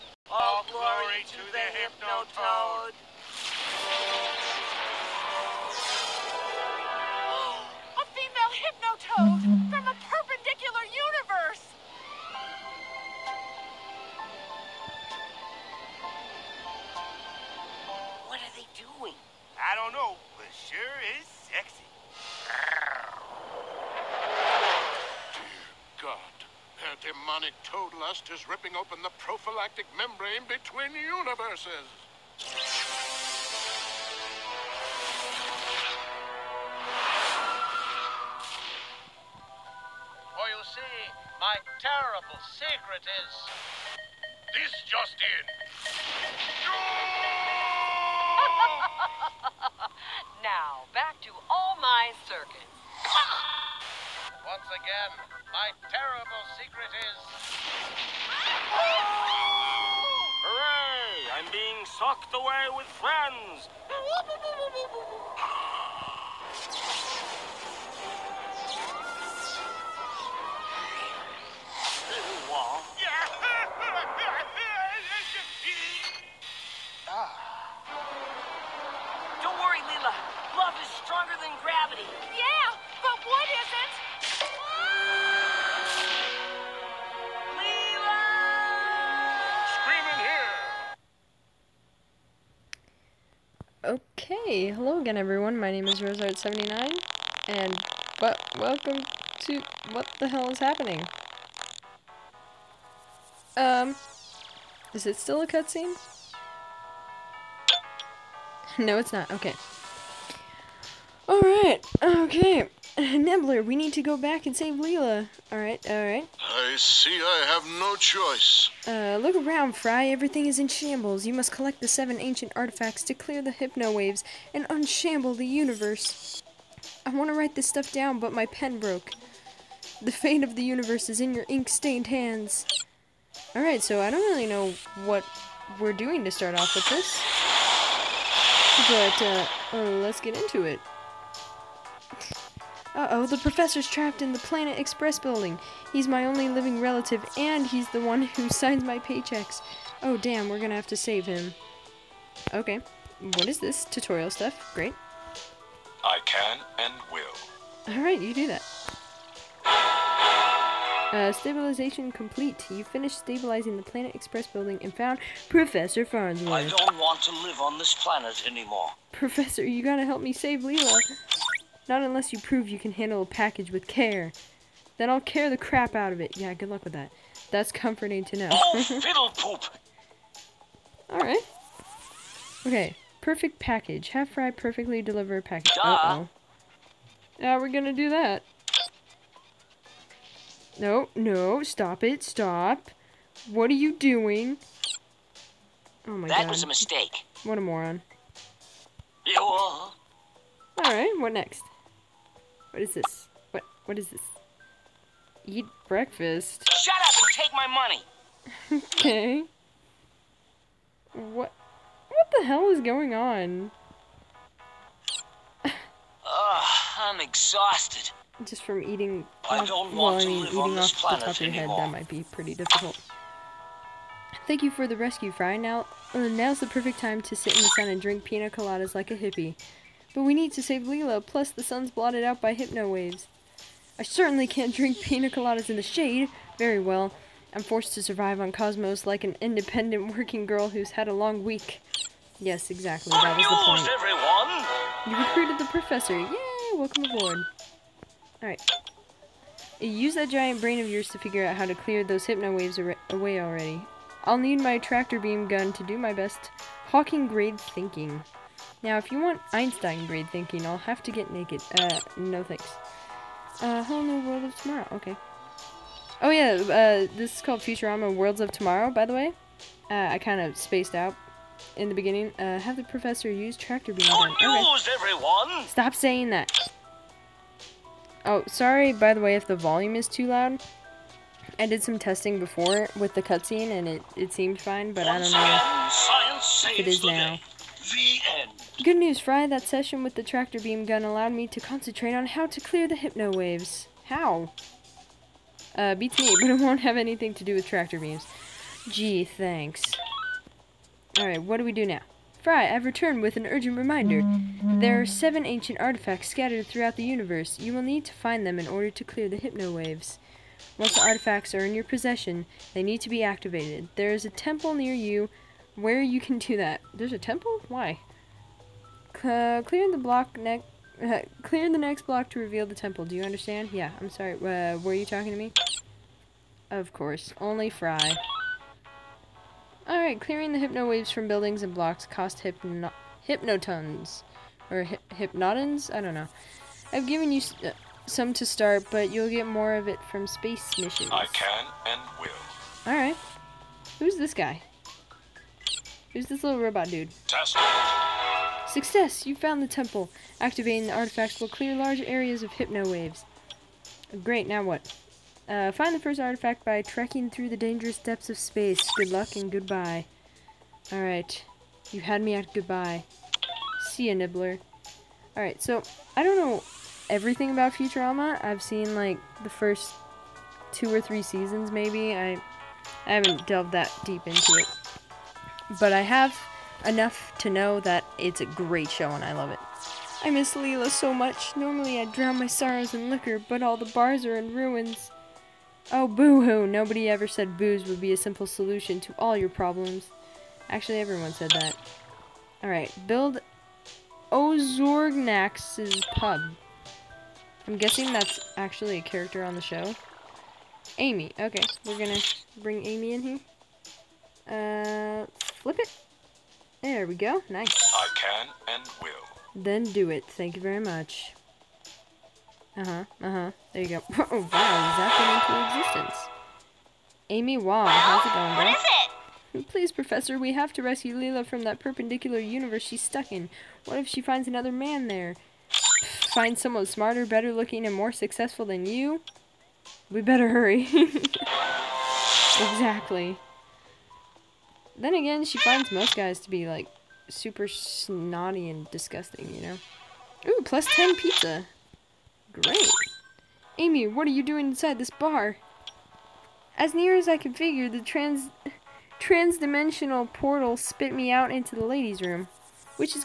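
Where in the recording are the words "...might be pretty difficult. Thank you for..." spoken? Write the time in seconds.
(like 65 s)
221 s.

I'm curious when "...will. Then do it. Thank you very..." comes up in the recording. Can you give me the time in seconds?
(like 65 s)
409 s.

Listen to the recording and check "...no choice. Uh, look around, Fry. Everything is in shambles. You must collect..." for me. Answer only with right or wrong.
right.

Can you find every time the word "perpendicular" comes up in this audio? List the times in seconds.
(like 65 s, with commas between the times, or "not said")
9 s, 421 s.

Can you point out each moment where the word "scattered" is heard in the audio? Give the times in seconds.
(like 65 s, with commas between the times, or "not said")
306 s.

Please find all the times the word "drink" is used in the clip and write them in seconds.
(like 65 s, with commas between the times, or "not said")
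228 s, 234 s.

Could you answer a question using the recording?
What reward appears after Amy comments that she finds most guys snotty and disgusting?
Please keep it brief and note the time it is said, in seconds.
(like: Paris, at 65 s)
10 pizza, at 440 s.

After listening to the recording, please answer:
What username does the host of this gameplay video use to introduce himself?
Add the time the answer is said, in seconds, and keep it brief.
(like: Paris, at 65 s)
RoseArt79, at 95 s.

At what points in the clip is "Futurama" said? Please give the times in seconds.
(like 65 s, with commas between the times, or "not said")
267 s, 367 s.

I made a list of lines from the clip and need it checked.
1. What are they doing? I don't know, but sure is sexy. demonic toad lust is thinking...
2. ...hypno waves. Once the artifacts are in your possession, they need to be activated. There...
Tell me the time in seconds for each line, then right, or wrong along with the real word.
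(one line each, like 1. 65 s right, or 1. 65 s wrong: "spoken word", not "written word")
1. 18 s wrong: "ripping", not "thinking"
2. 309 s right.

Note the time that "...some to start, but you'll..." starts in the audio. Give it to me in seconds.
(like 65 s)
338 s.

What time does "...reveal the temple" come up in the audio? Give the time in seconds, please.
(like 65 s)
322 s.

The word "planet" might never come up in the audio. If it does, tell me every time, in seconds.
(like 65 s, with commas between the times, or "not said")
144 s, 163 s, 167 s.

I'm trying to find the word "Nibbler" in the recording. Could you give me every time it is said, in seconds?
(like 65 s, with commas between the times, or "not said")
112 s, 364 s.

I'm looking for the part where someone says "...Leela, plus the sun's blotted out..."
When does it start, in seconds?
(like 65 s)
230 s.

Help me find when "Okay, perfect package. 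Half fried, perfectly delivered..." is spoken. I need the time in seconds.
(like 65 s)
182 s.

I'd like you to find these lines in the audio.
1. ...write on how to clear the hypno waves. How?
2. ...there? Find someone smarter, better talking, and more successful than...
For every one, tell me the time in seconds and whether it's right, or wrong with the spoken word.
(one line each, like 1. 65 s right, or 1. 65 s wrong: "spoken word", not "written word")
1. 291 s wrong: "concentrate", not "write"
2. 425 s wrong: "looking", not "talking".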